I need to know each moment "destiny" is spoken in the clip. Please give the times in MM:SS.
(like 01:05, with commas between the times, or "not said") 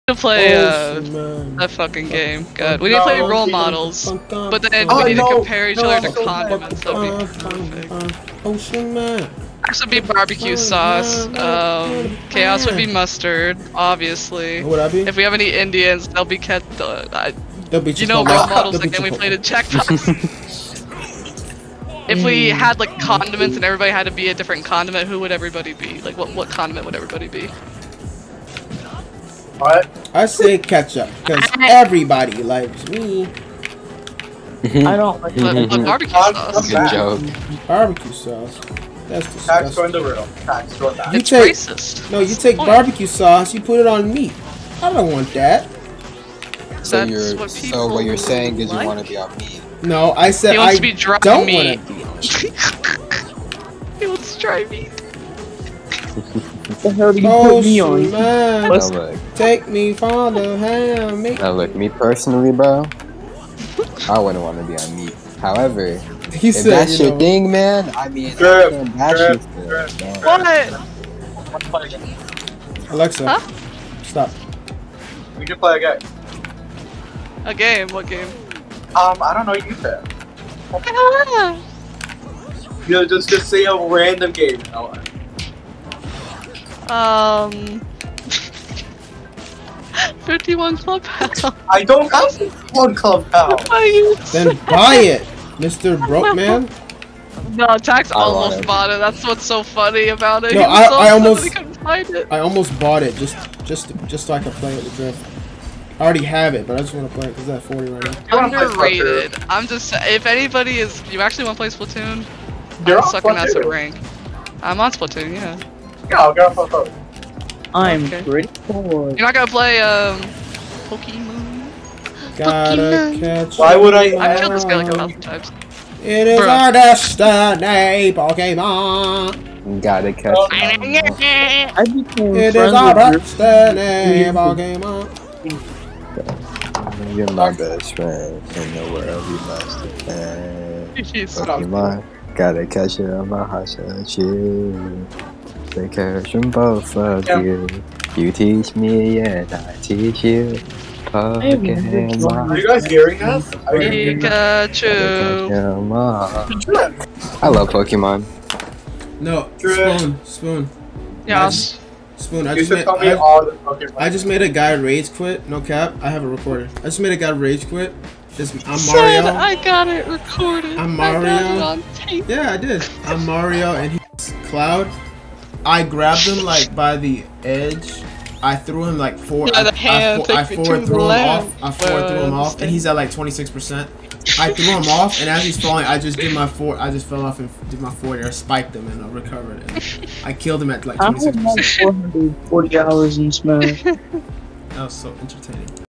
02:06, 02:12.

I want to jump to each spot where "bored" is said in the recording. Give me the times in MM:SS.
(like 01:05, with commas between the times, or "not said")
01:58.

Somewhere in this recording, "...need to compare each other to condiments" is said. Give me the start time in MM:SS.
00:05.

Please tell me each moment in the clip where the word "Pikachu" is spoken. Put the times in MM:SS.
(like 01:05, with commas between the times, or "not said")
02:33.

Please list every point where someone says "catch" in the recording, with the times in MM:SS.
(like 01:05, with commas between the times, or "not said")
02:03, 02:10, 02:22.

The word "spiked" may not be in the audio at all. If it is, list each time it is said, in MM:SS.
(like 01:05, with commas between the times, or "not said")
03:08.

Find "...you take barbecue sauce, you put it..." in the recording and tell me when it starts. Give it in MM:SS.
00:42.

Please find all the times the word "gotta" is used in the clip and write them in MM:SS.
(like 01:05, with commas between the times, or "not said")
02:02, 02:09, 02:22.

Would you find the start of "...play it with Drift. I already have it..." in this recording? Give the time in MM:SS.
01:44.